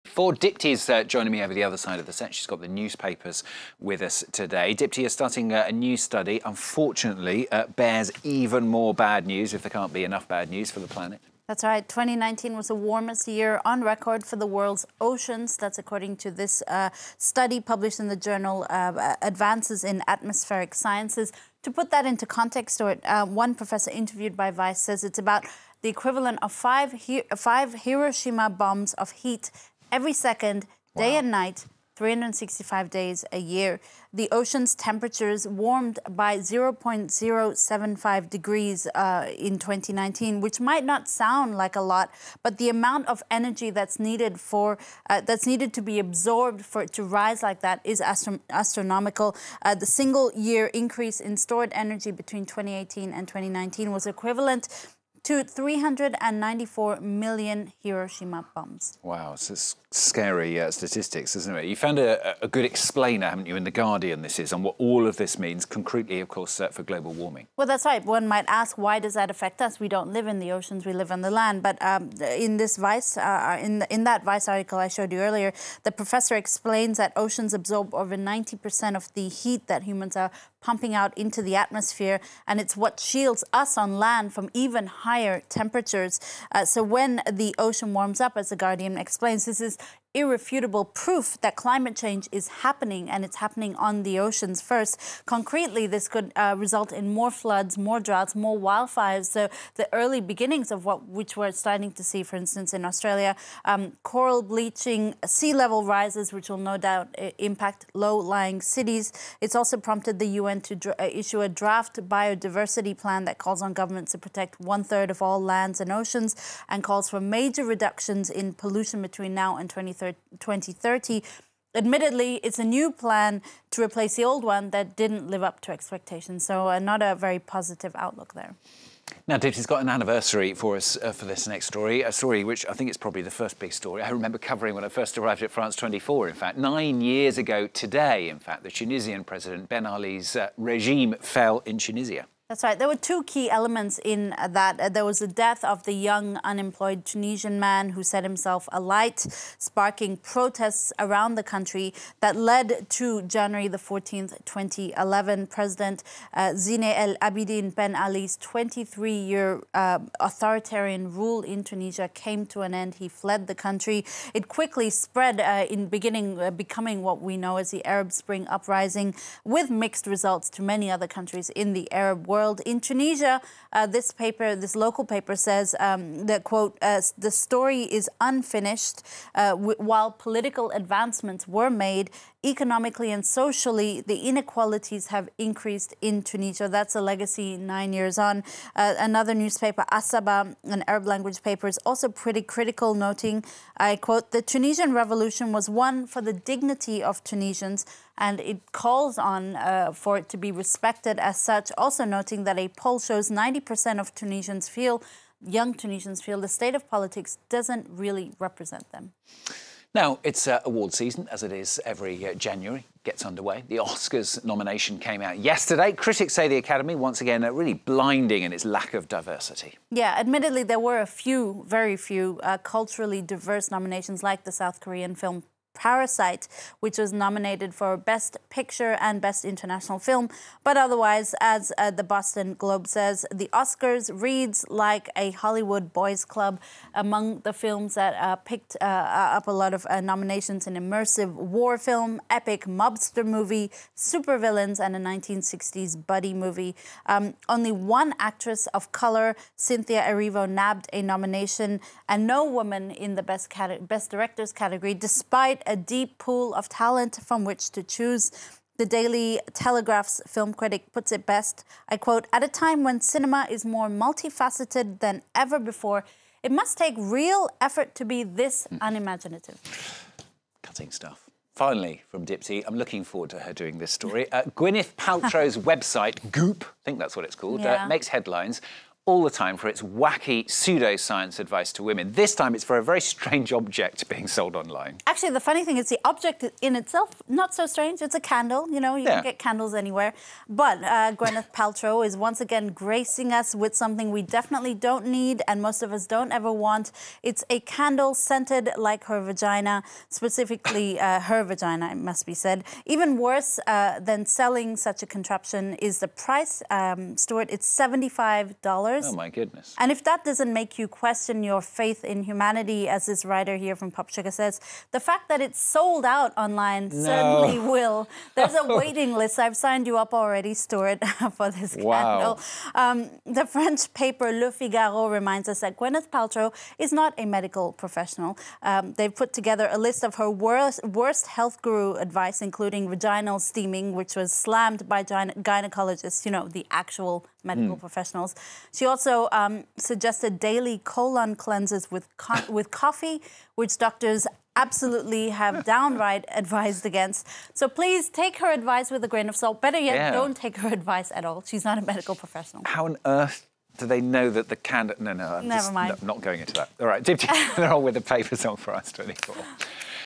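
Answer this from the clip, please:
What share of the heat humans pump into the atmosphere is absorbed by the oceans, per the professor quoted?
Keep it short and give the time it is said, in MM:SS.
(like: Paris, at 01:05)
over 90%, at 01:17.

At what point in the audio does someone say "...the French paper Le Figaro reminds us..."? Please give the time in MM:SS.
05:23.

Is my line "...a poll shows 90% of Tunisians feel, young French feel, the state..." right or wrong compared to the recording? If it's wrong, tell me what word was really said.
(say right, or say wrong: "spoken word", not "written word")
wrong: "Tunisians", not "French".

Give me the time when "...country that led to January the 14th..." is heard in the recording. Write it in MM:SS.
02:31.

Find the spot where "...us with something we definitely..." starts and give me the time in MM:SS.
04:53.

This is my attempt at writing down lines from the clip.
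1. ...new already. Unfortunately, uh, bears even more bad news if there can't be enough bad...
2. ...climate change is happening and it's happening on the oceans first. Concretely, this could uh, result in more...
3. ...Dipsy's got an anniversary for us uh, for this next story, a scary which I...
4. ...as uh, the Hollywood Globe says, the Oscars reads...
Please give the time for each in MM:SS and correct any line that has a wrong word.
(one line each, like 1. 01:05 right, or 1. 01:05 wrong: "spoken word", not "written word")
1. 00:05 wrong: "study", not "already"
2. 01:31 right
3. 02:09 wrong: "story", not "scary"
4. 03:51 wrong: "Boston", not "Hollywood".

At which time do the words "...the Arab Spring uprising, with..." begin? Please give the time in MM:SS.
02:47.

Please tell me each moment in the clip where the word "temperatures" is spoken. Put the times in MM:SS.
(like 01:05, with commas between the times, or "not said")
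00:34, 01:25.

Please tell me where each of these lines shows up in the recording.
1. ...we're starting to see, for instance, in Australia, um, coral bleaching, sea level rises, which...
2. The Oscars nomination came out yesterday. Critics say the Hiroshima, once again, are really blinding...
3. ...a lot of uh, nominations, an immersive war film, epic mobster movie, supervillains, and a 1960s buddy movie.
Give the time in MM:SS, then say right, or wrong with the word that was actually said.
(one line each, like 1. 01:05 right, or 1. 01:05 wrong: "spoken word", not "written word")
1. 01:41 right
2. 03:33 wrong: "Academy", not "Hiroshima"
3. 03:59 right.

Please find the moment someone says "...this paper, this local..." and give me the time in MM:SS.
02:53.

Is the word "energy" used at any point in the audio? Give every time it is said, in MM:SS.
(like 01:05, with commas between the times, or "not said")
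00:43, 00:51.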